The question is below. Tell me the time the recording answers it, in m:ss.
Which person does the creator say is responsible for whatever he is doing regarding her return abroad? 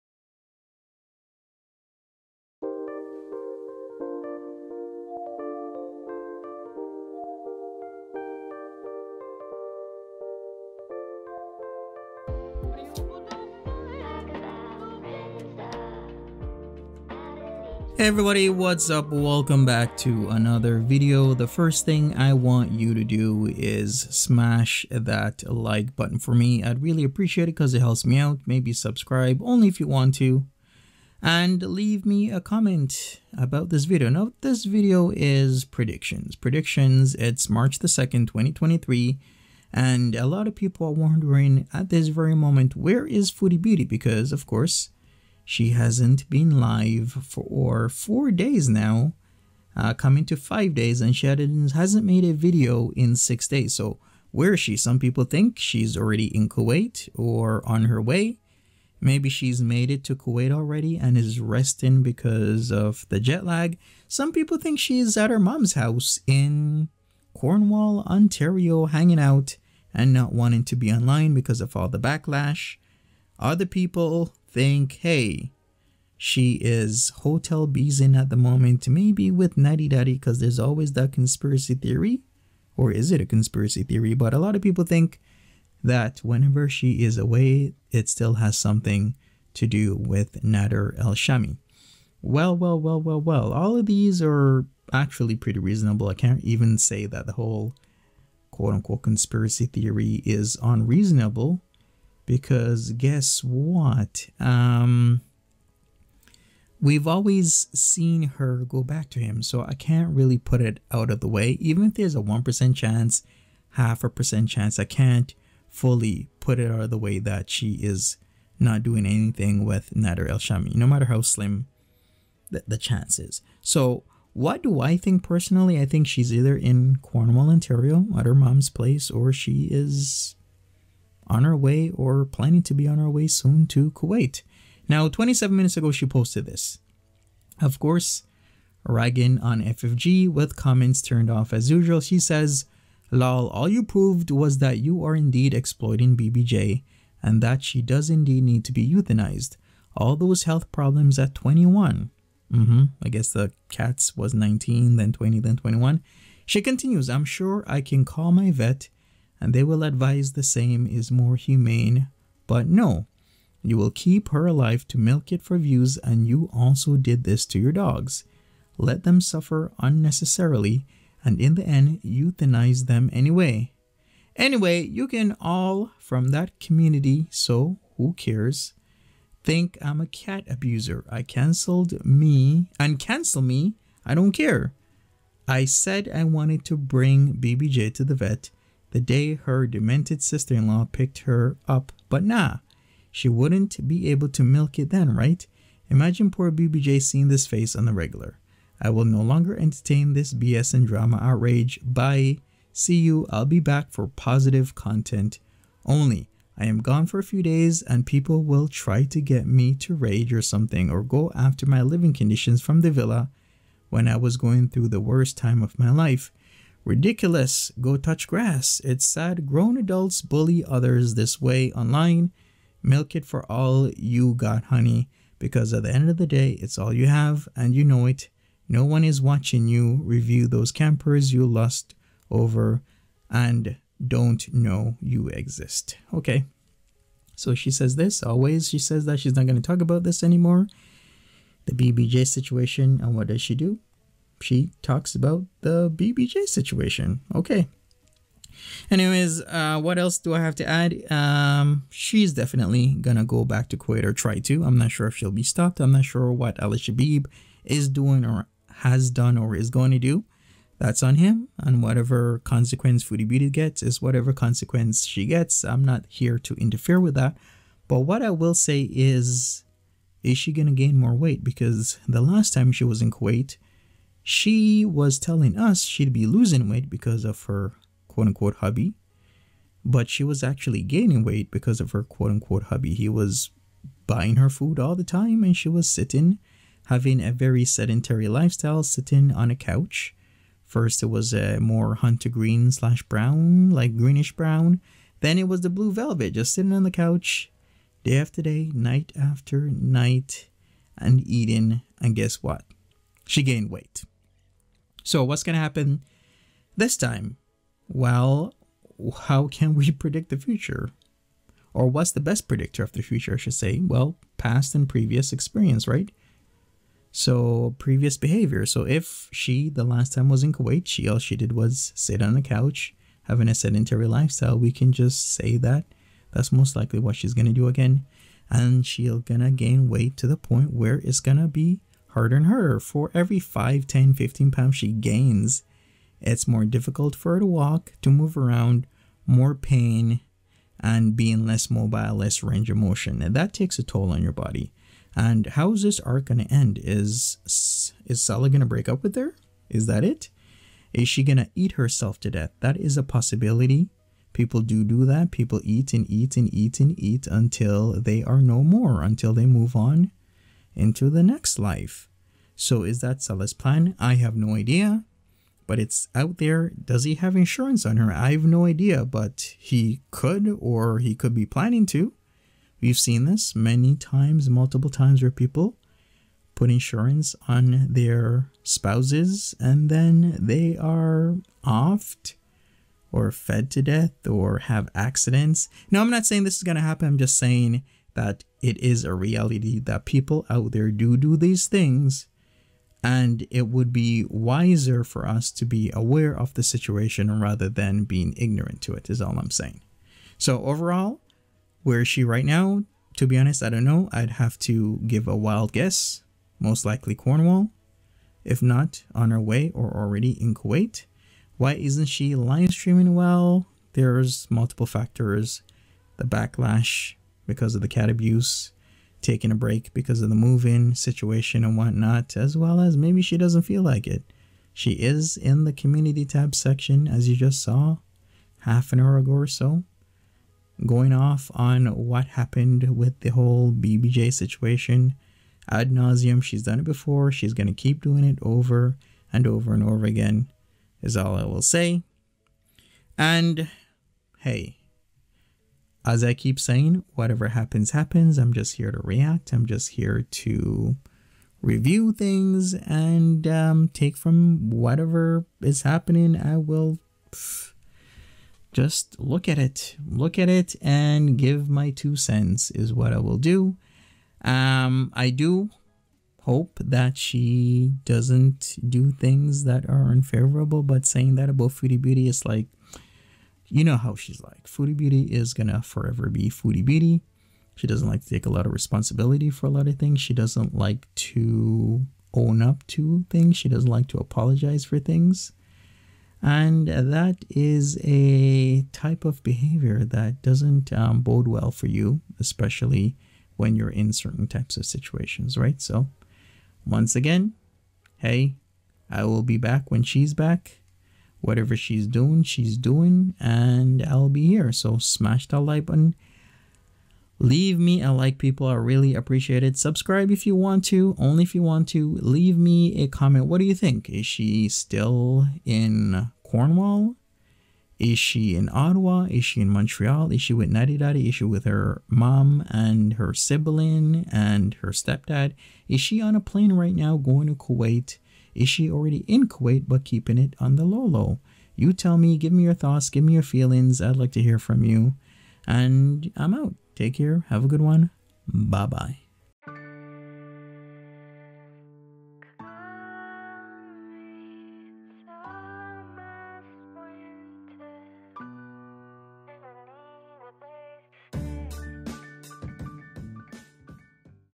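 4:16.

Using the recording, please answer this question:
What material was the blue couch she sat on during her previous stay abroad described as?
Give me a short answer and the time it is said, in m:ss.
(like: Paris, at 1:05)
velvet, at 4:55.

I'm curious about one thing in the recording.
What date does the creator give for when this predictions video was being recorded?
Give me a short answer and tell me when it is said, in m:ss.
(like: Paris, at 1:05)
March 2, 2023, at 0:37.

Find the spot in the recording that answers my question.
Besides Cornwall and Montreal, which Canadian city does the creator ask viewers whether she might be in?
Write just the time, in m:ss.
8:38.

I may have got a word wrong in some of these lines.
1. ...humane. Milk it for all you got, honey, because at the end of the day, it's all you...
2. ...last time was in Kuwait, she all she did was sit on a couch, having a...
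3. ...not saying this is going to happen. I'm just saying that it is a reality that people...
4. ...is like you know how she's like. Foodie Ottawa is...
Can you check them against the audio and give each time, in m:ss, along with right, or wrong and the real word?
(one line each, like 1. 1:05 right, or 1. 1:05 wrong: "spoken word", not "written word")
1. 3:41 wrong: "online", not "humane"
2. 5:19 right
3. 6:26 right
4. 7:52 wrong: "Beauty", not "Ottawa".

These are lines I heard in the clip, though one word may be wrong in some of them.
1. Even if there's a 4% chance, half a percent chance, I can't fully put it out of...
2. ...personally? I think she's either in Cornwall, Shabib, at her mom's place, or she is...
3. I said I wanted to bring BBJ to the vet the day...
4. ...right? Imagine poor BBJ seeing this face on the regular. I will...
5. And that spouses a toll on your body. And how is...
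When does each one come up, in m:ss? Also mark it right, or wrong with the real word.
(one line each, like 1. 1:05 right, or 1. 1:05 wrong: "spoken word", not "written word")
1. 1:51 wrong: "1", not "4"
2. 2:05 wrong: "Ontario", not "Shabib"
3. 3:05 right
4. 3:15 right
5. 5:43 wrong: "takes", not "spouses".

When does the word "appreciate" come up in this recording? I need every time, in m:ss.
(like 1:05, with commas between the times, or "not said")
0:27, 8:29.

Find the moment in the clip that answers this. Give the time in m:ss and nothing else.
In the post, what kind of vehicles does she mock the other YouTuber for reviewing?
3:50.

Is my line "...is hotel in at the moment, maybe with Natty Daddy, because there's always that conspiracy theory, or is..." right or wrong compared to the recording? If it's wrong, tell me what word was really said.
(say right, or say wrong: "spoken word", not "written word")
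right.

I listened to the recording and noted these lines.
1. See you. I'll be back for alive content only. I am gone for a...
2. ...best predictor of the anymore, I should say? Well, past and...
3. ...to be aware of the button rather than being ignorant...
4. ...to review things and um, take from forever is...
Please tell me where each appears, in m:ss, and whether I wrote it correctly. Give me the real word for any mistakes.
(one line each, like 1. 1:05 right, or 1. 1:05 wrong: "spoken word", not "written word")
1. 3:22 wrong: "positive", not "alive"
2. 5:12 wrong: "future", not "anymore"
3. 6:35 wrong: "situation", not "button"
4. 7:30 wrong: "whatever", not "forever".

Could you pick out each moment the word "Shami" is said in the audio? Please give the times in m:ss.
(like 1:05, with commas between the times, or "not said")
1:31, 2:00.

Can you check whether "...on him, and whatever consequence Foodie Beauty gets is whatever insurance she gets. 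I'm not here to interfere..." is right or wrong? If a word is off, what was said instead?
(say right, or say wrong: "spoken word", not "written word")
wrong: "consequence", not "insurance".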